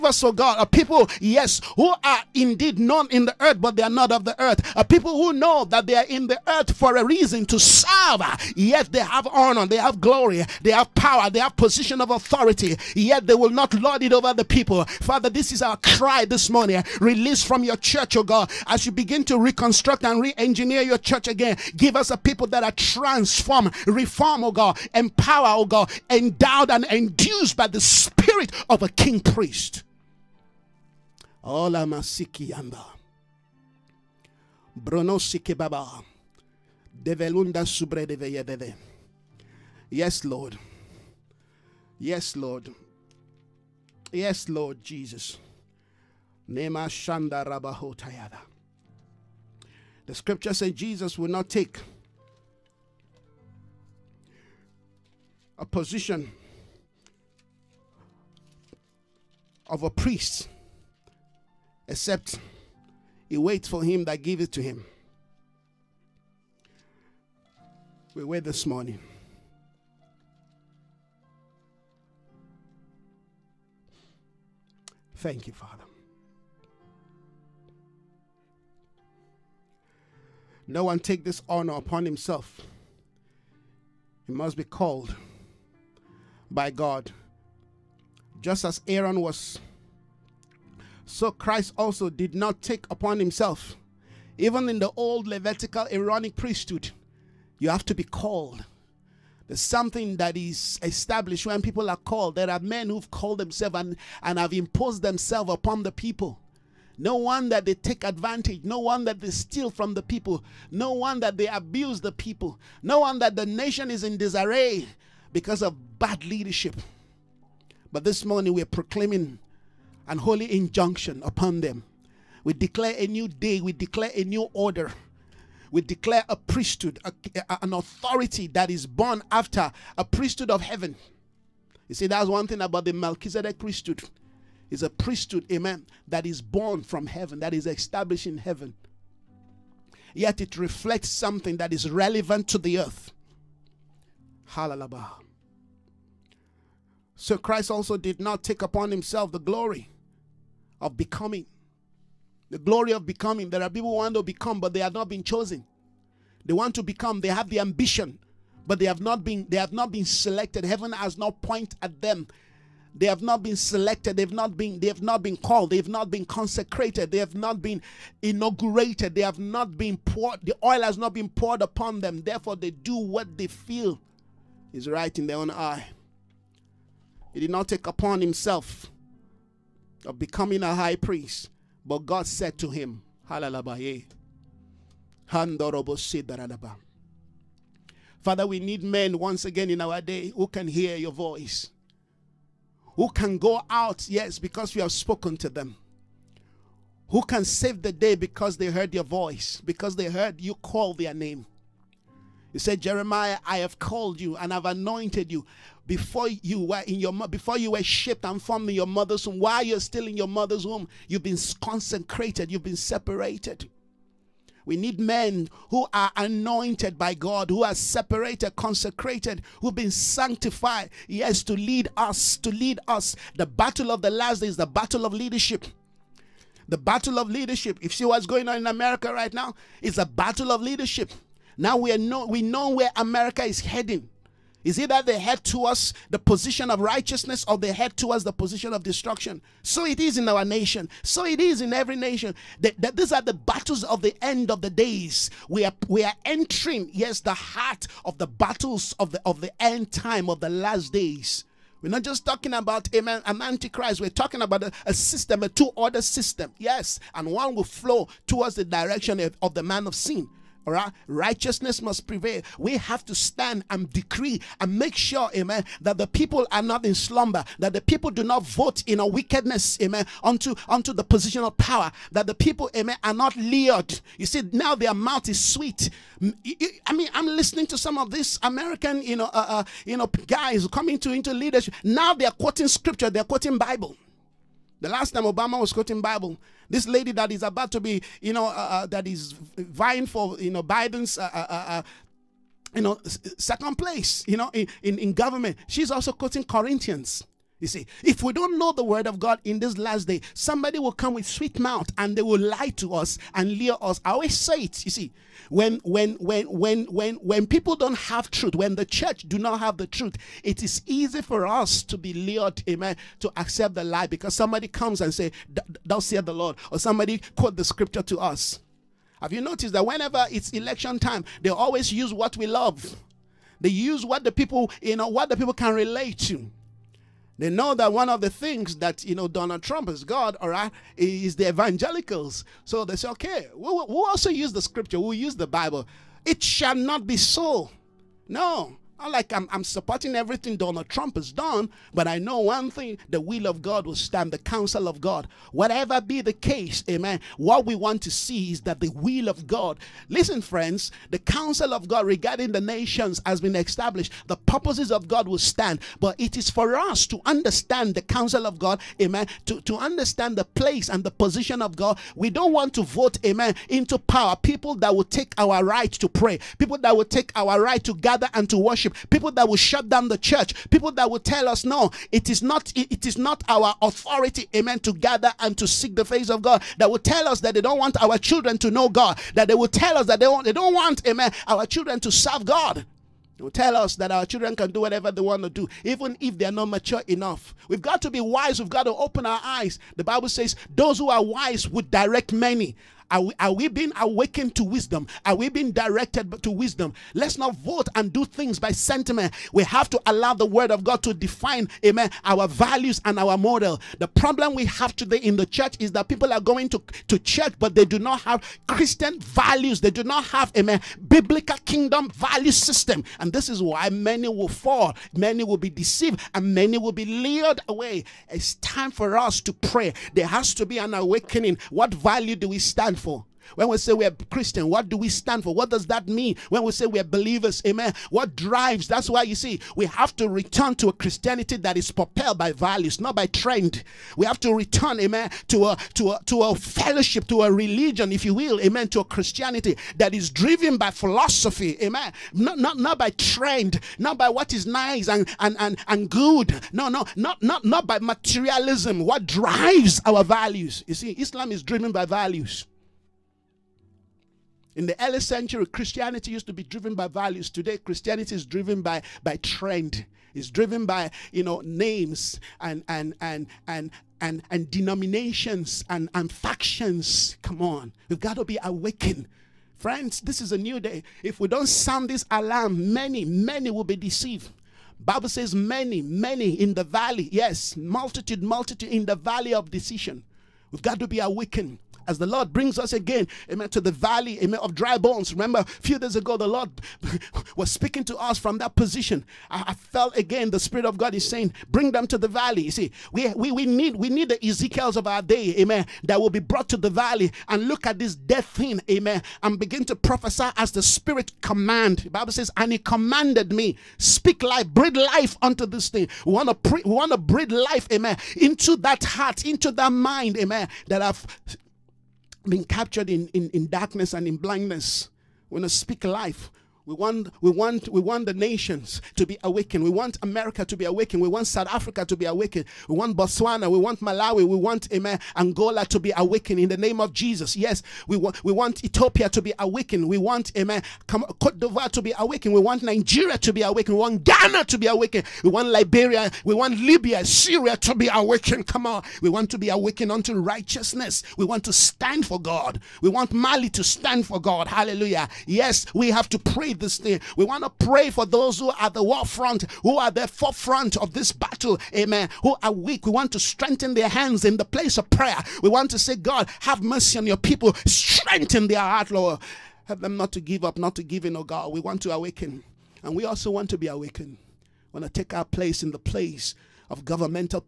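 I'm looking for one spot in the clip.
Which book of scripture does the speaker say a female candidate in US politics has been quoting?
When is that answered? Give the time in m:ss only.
4:56.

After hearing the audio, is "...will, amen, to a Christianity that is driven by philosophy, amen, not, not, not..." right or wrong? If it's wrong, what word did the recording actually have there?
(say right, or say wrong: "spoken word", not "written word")
right.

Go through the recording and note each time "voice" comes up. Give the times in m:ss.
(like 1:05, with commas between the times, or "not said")
3:11, 3:19.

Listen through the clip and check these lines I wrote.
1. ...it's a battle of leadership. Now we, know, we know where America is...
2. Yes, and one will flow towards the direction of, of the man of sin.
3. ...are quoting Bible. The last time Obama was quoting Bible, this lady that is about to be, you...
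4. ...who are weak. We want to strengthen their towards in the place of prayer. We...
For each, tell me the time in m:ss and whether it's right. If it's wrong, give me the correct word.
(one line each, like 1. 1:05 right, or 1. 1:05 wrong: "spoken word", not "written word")
1. 3:49 right
2. 4:16 right
3. 4:43 right
4. 9:12 wrong: "hands", not "towards".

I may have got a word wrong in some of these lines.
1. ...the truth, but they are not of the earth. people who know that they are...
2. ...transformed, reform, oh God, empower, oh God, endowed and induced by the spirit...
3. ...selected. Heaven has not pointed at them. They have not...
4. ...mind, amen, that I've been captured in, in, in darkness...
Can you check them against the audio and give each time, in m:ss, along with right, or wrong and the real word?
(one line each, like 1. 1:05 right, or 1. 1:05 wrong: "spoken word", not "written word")
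1. 0:03 wrong: "earth", not "truth"
2. 0:22 right
3. 2:40 right
4. 8:29 right.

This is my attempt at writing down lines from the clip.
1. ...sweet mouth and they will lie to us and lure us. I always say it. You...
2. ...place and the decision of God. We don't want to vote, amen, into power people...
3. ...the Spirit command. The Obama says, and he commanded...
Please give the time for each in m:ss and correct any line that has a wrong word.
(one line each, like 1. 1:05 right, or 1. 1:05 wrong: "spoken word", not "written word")
1. 5:01 right
2. 6:00 wrong: "position", not "decision"
3. 8:20 wrong: "Bible", not "Obama".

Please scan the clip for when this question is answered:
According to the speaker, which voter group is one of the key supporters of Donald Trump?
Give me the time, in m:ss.
5:31.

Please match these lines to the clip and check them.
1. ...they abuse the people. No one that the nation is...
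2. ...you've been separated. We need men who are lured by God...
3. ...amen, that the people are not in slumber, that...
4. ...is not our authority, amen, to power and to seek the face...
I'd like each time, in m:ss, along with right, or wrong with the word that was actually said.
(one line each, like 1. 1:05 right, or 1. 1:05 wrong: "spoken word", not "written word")
1. 1:51 right
2. 3:32 wrong: "anointed", not "lured"
3. 4:25 right
4. 6:13 wrong: "gather", not "power".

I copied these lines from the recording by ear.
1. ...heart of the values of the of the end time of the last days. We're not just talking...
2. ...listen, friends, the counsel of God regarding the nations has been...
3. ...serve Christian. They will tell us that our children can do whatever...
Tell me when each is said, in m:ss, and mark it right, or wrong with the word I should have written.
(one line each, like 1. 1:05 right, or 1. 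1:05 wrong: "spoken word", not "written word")
1. 4:07 wrong: "battles", not "values"
2. 5:50 right
3. 6:22 wrong: "God", not "Christian".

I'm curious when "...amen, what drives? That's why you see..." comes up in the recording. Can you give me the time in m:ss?
7:07.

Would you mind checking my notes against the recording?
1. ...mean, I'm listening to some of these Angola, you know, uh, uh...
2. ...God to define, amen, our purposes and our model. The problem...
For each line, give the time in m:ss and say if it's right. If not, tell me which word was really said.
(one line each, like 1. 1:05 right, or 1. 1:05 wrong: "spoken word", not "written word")
1. 4:36 wrong: "American", not "Angola"
2. 6:40 wrong: "values", not "purposes".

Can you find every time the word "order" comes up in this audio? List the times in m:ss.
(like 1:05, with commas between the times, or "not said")
2:04, 4:15.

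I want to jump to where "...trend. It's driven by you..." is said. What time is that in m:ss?
7:39.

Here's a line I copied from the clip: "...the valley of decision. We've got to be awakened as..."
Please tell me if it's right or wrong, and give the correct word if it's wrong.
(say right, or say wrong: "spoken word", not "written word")
right.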